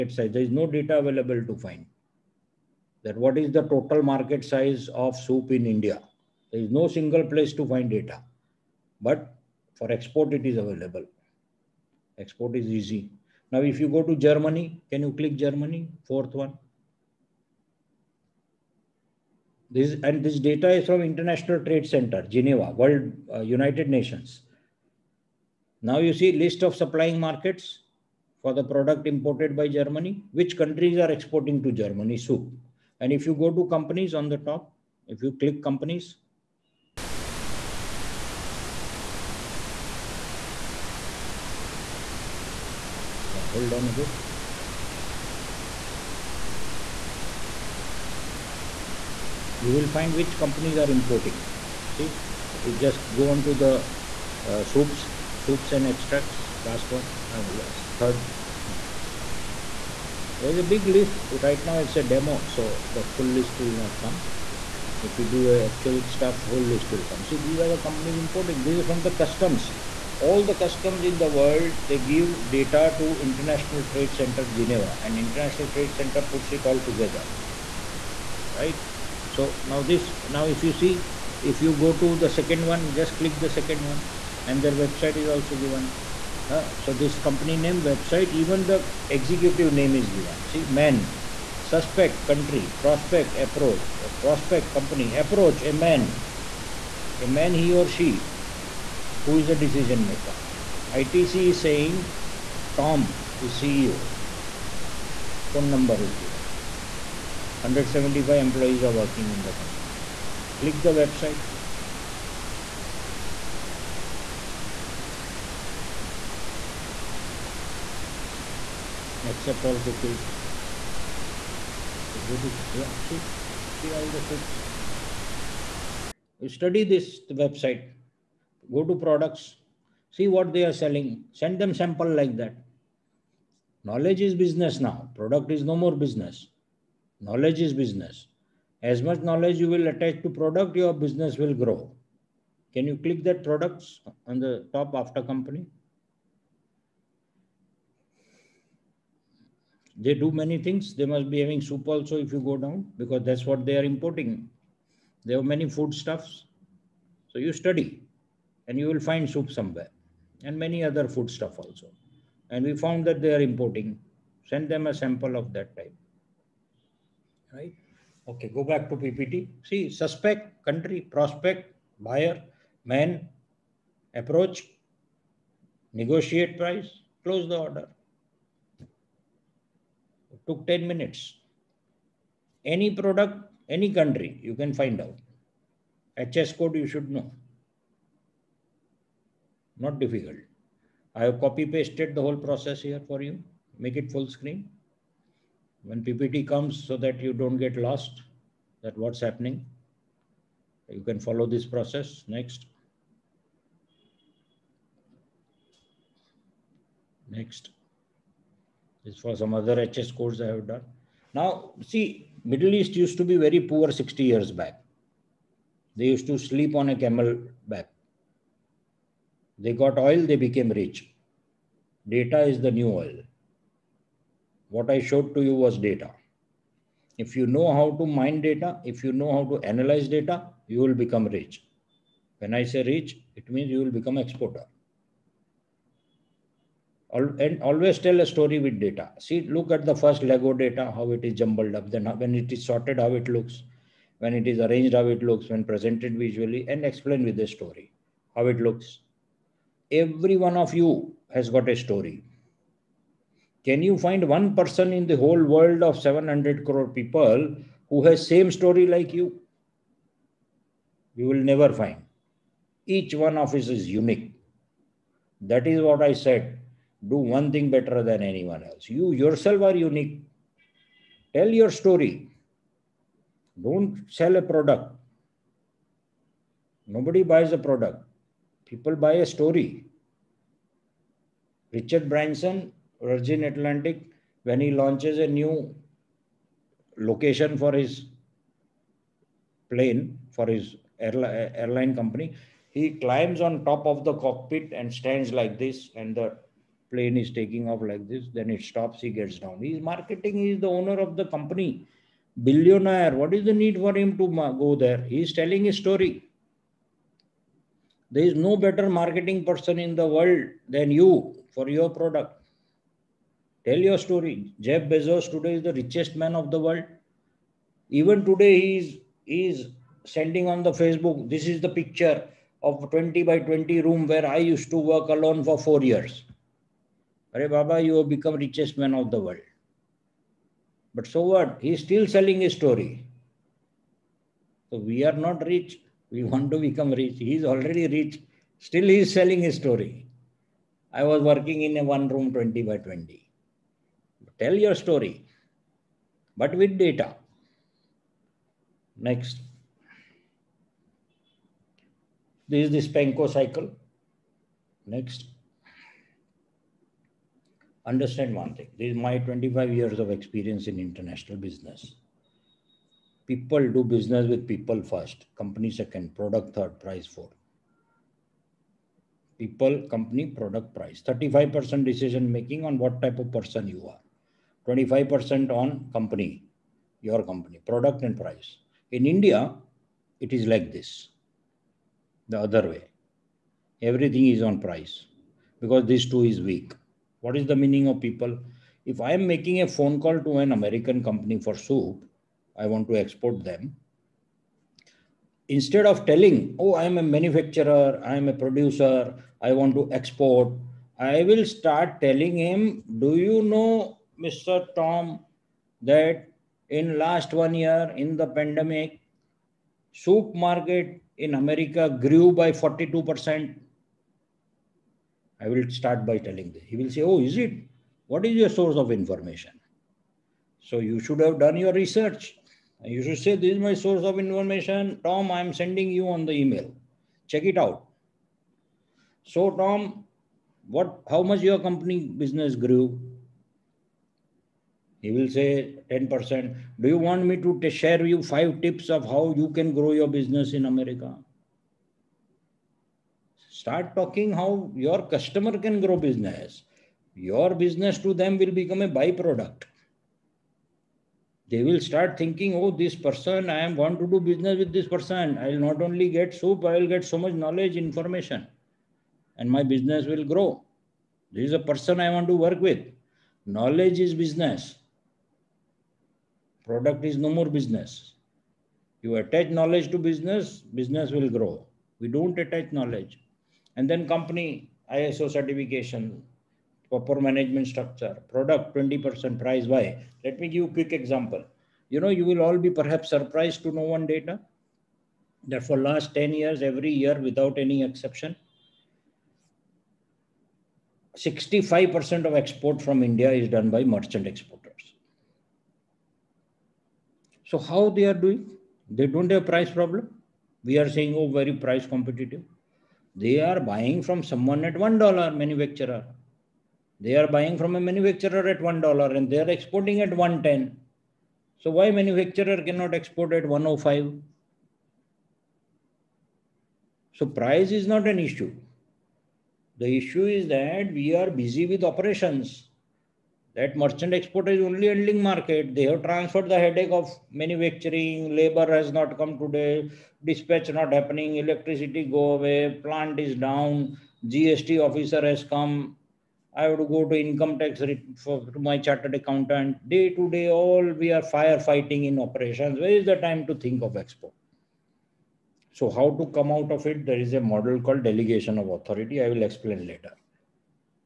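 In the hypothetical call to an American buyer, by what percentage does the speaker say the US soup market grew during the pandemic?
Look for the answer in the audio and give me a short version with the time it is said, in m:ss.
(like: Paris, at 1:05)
42%, at 6:52.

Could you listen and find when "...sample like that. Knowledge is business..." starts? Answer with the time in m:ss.
2:11.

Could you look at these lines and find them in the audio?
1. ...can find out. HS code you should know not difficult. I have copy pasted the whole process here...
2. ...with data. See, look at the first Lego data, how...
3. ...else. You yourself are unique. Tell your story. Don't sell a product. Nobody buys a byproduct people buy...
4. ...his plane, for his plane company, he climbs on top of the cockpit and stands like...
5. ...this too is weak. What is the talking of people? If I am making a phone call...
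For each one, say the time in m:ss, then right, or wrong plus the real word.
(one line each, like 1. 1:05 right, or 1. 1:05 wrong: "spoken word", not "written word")
1. 3:04 right
2. 3:58 right
3. 4:28 wrong: "product", not "byproduct"
4. 4:47 wrong: "airline", not "plane"
5. 6:25 wrong: "meaning", not "talking".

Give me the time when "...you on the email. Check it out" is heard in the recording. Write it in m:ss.
7:05.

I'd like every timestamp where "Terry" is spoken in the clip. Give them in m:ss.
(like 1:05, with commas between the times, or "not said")
not said.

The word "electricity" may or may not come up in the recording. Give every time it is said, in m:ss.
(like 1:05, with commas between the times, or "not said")
8:51.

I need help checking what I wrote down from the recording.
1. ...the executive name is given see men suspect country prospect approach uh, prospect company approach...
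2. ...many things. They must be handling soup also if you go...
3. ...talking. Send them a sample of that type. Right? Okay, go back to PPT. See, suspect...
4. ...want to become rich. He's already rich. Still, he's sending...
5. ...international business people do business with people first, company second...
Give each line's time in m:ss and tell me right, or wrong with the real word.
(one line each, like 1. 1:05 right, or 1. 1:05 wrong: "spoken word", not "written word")
1. 1:28 right
2. 2:30 wrong: "having", not "handling"
3. 2:43 wrong: "importing", not "talking"
4. 5:36 wrong: "selling", not "sending"
5. 6:00 right.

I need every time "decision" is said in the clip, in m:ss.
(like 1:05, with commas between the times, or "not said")
1:39, 6:11.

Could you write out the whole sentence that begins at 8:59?
Day to day, all we are firefighting in operations.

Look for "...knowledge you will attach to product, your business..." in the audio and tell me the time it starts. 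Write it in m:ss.
2:19.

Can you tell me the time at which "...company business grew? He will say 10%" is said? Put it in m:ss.
7:11.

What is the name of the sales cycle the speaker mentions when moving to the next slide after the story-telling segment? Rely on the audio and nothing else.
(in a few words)
SPANCO.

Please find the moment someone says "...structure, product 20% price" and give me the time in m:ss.
7:57.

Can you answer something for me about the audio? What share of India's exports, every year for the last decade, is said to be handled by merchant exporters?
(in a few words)
65%.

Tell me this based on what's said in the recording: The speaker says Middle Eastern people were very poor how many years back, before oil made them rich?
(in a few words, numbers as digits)
60.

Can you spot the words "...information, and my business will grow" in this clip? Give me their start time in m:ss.
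7:37.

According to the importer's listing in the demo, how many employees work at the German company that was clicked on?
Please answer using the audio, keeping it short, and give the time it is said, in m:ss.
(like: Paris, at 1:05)
175, at 1:47.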